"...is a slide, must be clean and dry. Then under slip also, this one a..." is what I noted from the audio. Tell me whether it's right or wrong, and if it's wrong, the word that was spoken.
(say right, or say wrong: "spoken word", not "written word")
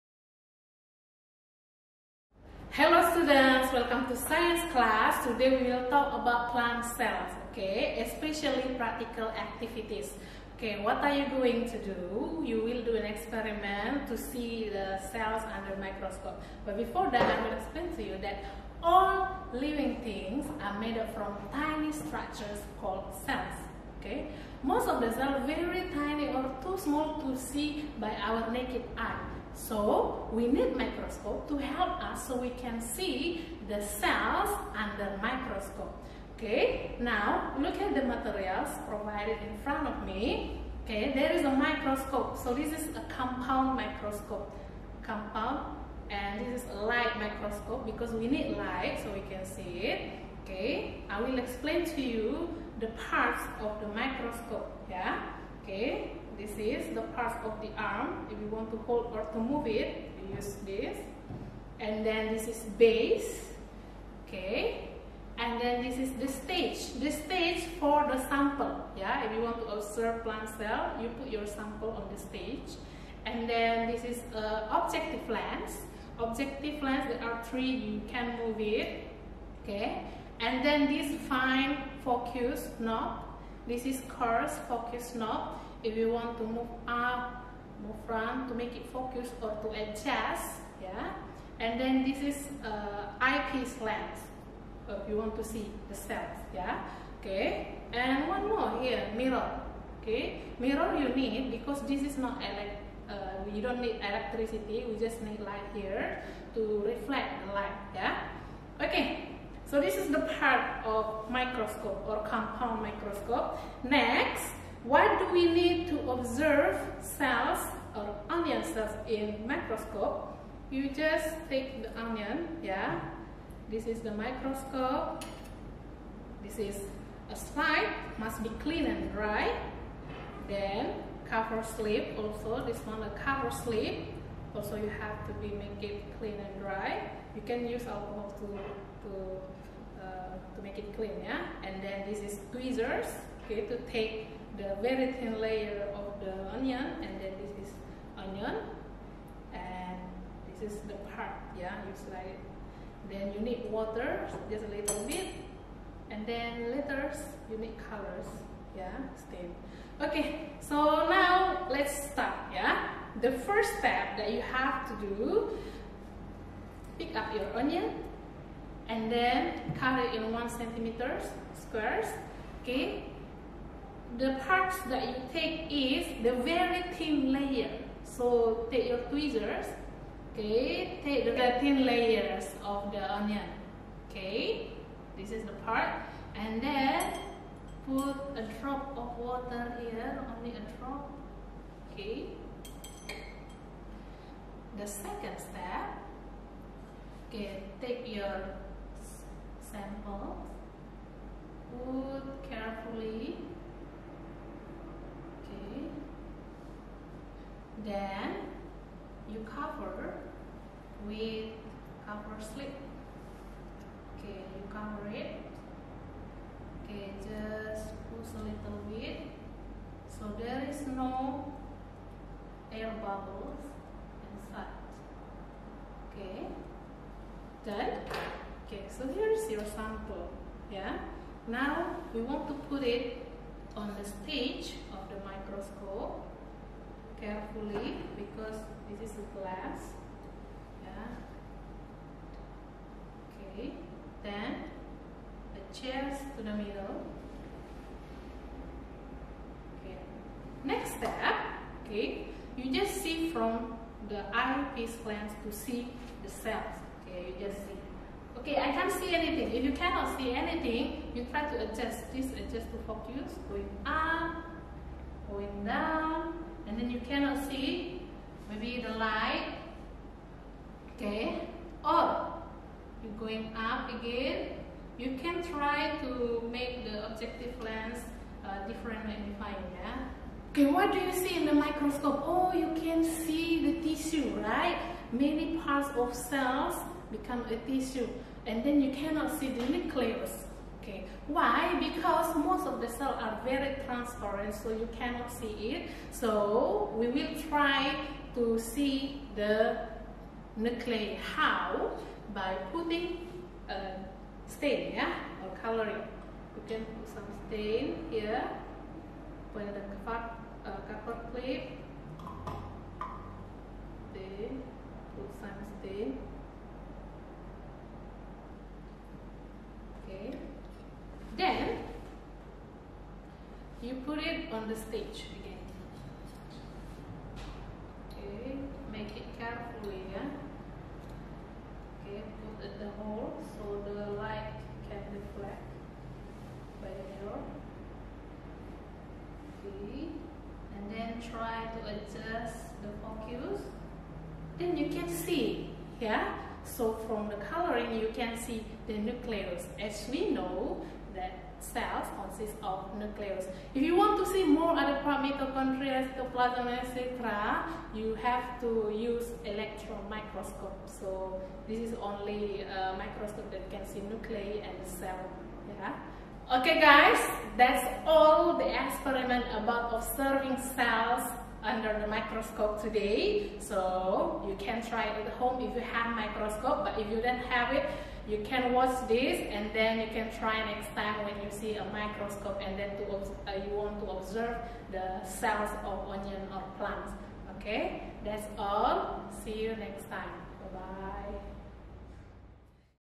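wrong: "cover", not "under".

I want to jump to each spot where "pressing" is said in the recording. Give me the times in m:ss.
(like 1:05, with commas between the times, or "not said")
not said.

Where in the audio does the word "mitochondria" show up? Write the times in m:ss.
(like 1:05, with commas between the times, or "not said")
5:55.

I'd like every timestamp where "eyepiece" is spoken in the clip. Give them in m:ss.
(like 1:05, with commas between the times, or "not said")
1:33, 4:14.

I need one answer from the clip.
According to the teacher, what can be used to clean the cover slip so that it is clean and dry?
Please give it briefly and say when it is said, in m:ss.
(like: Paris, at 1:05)
Alcohol, at 2:17.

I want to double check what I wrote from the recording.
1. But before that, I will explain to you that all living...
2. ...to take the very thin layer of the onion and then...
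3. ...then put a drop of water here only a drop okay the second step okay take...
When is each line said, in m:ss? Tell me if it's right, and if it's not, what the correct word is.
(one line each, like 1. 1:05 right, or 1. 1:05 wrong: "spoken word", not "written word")
1. 0:16 right
2. 2:23 right
3. 3:06 right.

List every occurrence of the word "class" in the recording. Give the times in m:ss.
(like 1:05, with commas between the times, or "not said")
0:04.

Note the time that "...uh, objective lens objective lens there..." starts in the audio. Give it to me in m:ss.
1:14.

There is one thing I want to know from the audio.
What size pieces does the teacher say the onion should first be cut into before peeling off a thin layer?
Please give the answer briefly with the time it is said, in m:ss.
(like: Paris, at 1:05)
1 centimeter squares, at 2:50.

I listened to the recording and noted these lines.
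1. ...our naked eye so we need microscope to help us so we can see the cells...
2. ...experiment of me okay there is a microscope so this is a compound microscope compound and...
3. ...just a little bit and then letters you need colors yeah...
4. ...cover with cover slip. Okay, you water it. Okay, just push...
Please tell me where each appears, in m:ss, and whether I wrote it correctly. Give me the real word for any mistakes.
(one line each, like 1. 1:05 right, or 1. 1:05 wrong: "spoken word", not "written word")
1. 0:28 right
2. 0:39 wrong: "front", not "experiment"
3. 2:34 right
4. 3:29 wrong: "cover", not "water".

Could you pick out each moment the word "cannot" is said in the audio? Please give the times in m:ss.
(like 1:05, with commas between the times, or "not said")
4:19, 4:27, 4:48, 4:54.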